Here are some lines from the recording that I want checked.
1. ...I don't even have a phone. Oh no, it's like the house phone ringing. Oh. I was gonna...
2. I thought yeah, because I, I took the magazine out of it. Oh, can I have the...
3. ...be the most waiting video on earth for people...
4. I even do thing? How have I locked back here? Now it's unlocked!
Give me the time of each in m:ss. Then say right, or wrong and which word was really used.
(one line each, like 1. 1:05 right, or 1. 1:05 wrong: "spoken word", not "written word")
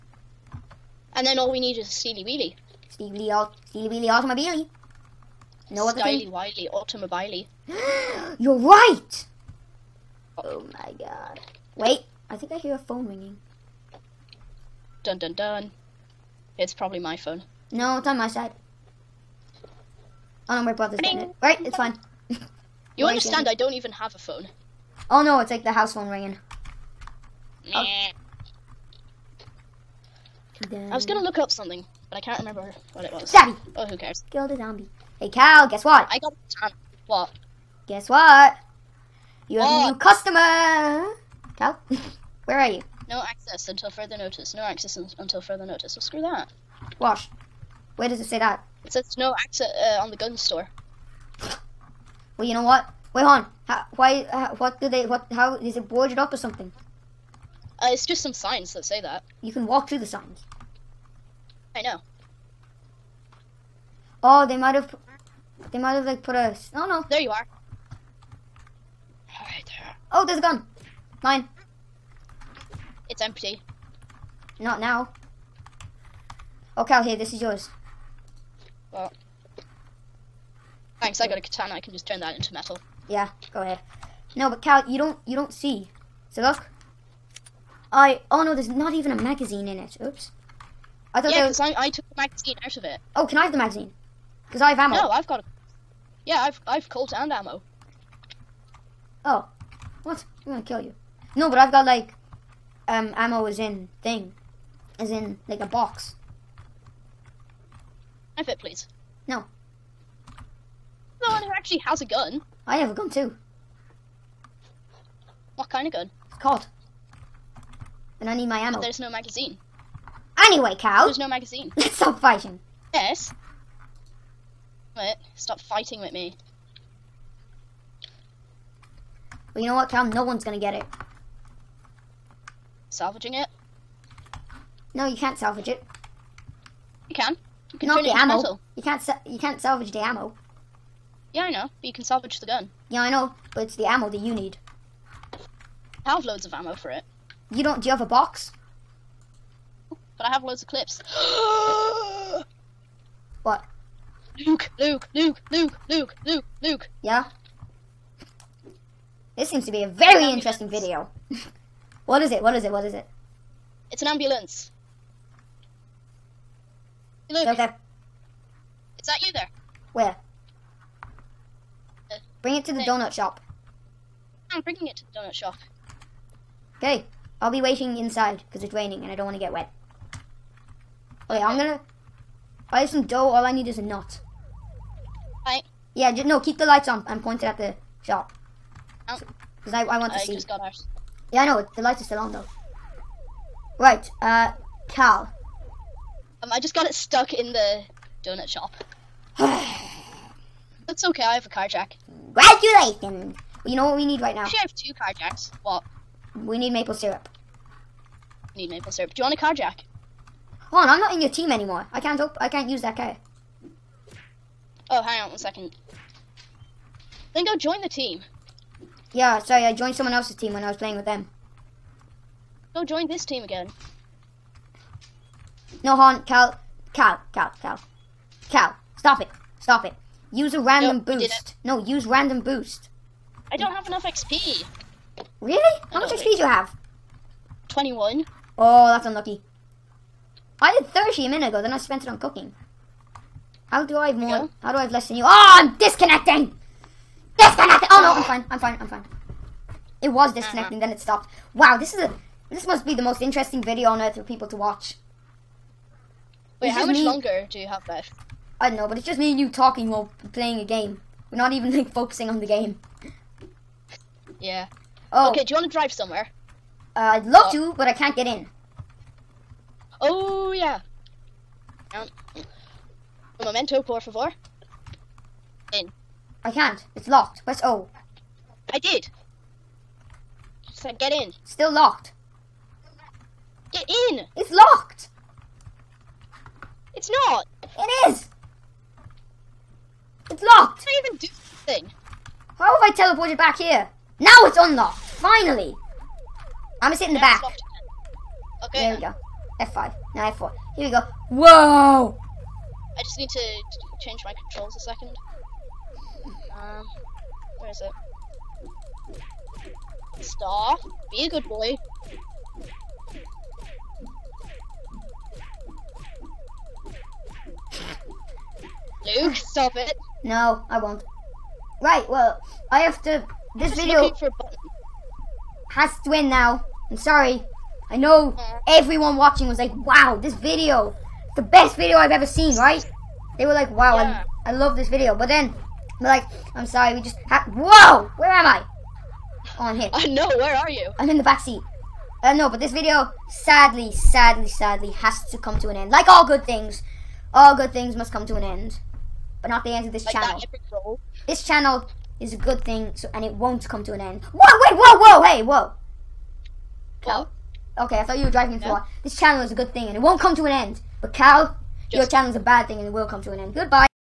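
1. 0:23 right
2. 1:31 right
3. 4:12 wrong: "interesting", not "waiting"
4. 4:50 wrong: "teleported", not "locked".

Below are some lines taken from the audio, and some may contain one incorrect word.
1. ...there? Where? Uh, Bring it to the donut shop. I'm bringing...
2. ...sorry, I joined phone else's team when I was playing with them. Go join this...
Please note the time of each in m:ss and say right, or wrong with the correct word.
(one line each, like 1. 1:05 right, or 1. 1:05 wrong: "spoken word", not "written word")
1. 2:49 right
2. 3:39 wrong: "someone", not "phone".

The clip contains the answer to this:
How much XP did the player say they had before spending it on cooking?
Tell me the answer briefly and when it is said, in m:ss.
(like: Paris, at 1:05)
30, at 4:00.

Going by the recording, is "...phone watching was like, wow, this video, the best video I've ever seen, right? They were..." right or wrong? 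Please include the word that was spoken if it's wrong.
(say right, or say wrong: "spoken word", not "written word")
wrong: "everyone", not "phone".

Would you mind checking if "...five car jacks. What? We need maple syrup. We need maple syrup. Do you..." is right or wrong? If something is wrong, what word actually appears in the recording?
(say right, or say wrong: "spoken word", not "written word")
wrong: "two", not "five".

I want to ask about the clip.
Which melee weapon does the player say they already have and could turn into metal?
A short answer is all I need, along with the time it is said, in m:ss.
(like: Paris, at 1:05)
katana, at 1:21.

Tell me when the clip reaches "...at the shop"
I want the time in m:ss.
3:07.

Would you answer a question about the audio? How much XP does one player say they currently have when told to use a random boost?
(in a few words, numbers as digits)
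21.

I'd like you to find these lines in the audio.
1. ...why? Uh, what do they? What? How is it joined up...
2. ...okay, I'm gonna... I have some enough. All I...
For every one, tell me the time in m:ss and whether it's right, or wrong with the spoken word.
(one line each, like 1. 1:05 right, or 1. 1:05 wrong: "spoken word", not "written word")
1. 0:53 wrong: "boarded", not "joined"
2. 3:01 wrong: "dough", not "enough".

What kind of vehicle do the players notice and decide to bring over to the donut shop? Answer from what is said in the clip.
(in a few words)
ambulance.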